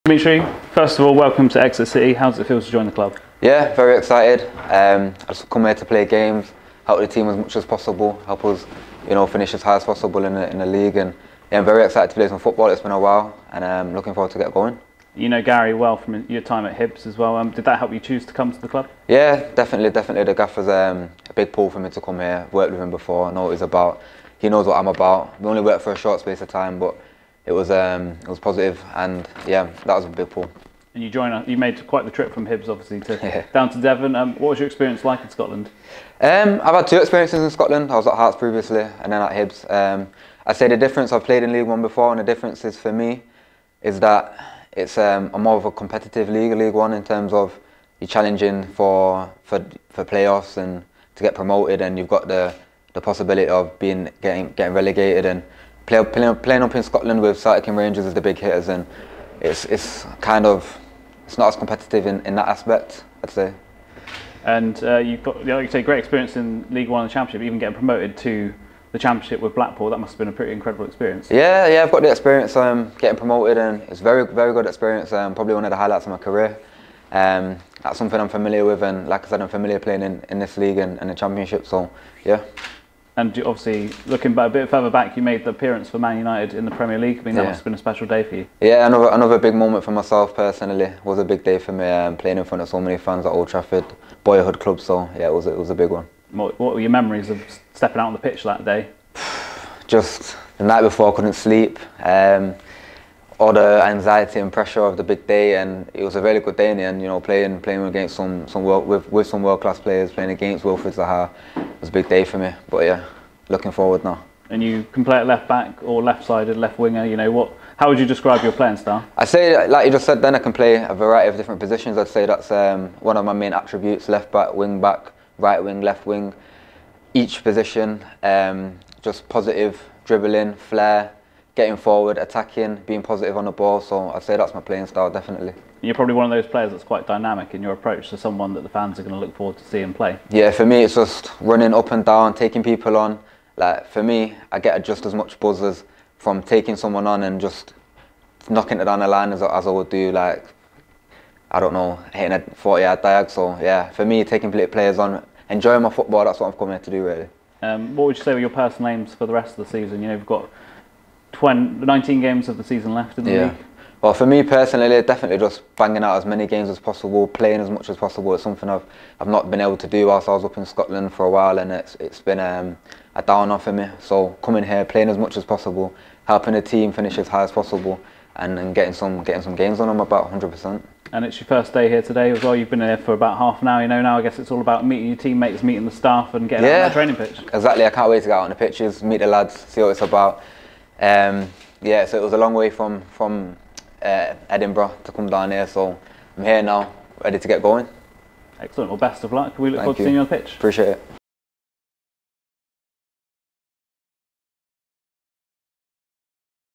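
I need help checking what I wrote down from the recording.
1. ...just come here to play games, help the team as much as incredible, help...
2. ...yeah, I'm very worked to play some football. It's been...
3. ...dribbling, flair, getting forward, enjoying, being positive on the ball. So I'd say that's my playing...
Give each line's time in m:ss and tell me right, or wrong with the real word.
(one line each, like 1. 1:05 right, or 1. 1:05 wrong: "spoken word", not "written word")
1. 0:05 wrong: "possible", not "incredible"
2. 0:11 wrong: "excited", not "worked"
3. 2:10 wrong: "attacking", not "enjoying".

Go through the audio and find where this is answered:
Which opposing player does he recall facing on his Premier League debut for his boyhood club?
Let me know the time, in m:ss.
1:50.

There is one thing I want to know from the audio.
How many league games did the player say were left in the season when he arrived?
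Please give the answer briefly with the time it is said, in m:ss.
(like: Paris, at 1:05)
19, at 2:41.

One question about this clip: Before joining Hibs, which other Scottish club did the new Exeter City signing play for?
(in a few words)
Hearts.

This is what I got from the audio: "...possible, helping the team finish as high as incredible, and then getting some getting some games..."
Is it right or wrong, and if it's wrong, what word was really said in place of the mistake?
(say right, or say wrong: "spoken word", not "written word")
wrong: "possible", not "incredible".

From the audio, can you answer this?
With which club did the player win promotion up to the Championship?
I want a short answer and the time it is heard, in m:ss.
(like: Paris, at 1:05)
Blackpool, at 1:09.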